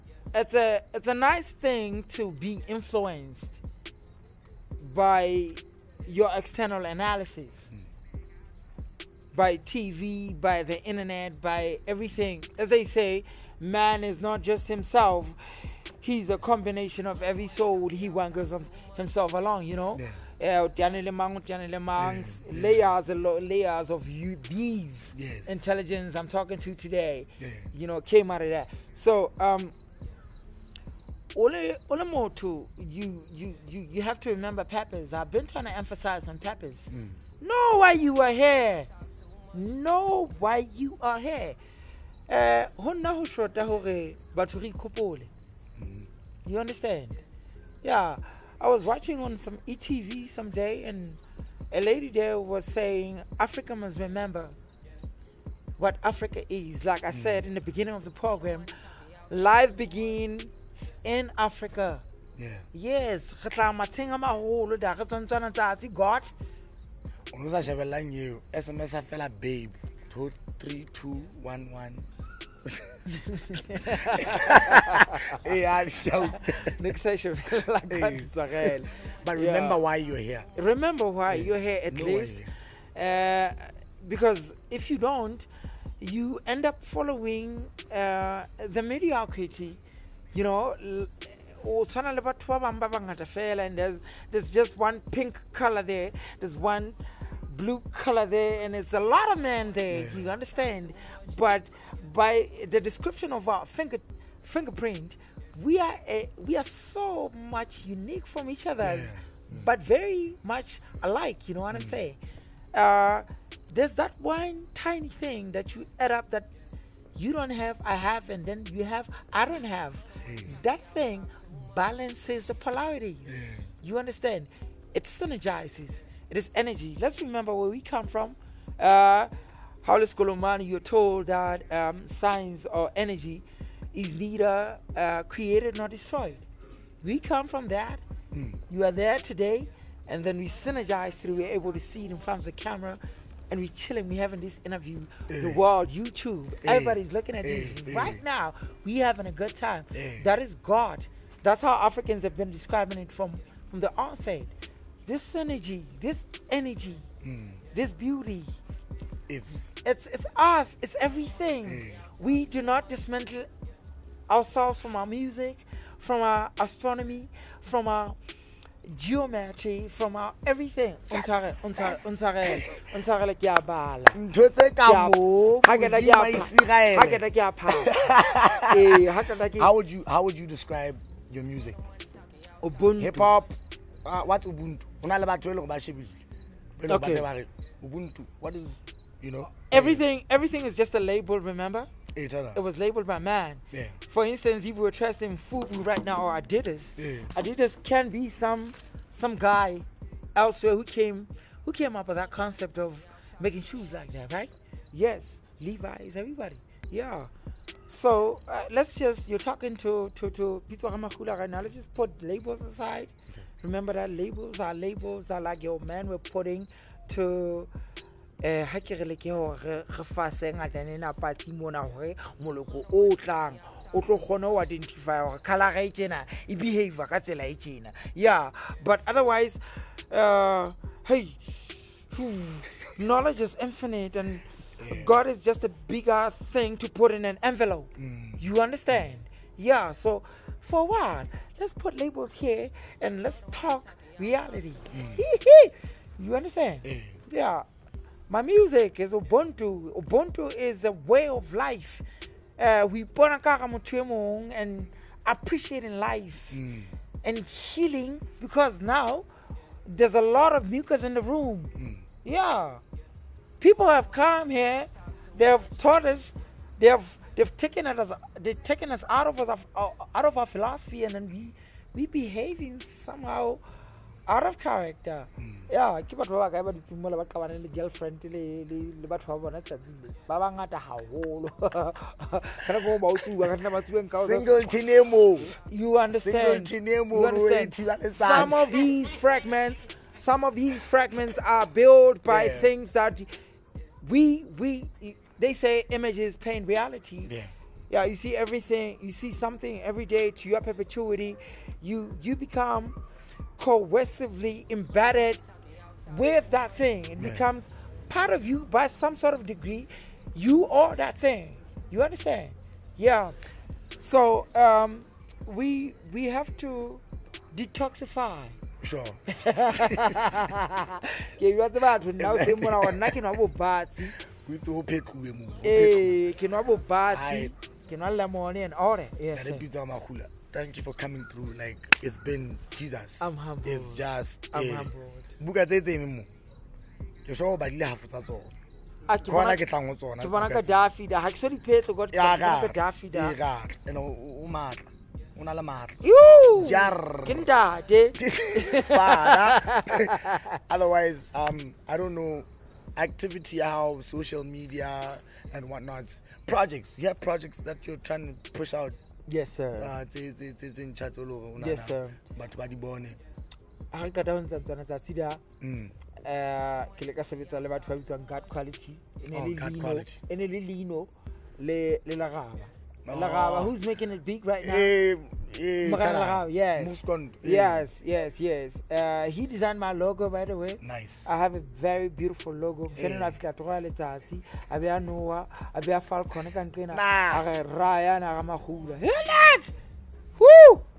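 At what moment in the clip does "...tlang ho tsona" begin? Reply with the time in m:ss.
5:39.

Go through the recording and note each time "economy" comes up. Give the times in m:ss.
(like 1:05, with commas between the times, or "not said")
not said.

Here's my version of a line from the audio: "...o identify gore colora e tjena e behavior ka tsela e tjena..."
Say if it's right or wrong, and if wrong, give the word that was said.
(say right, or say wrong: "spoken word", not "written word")
right.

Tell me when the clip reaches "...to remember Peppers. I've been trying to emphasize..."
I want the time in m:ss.
0:34.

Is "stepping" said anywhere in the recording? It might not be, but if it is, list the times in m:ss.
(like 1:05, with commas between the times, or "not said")
not said.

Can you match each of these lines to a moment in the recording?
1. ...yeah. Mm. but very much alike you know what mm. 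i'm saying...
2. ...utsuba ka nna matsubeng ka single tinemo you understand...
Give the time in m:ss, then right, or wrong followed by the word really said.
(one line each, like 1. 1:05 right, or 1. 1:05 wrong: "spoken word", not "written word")
1. 1:48 right
2. 4:43 right.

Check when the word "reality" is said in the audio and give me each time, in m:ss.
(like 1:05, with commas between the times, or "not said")
4:04, 4:56.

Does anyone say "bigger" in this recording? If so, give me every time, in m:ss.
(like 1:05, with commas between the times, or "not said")
3:55.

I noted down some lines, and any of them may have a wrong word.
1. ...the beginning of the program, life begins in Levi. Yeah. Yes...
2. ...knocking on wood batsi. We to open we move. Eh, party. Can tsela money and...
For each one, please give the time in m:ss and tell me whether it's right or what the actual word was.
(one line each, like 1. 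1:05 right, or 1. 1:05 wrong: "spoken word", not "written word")
1. 0:57 wrong: "Africa", not "Levi"
2. 5:22 wrong: "kinala", not "tsela".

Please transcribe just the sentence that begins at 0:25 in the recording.
intelligence I'm talking to today, yeah.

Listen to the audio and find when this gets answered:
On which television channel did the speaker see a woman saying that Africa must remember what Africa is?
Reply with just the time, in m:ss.
0:49.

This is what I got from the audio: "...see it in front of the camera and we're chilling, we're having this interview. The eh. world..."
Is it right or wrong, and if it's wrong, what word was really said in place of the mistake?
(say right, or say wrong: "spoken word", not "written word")
right.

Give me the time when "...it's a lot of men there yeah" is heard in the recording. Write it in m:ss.
1:38.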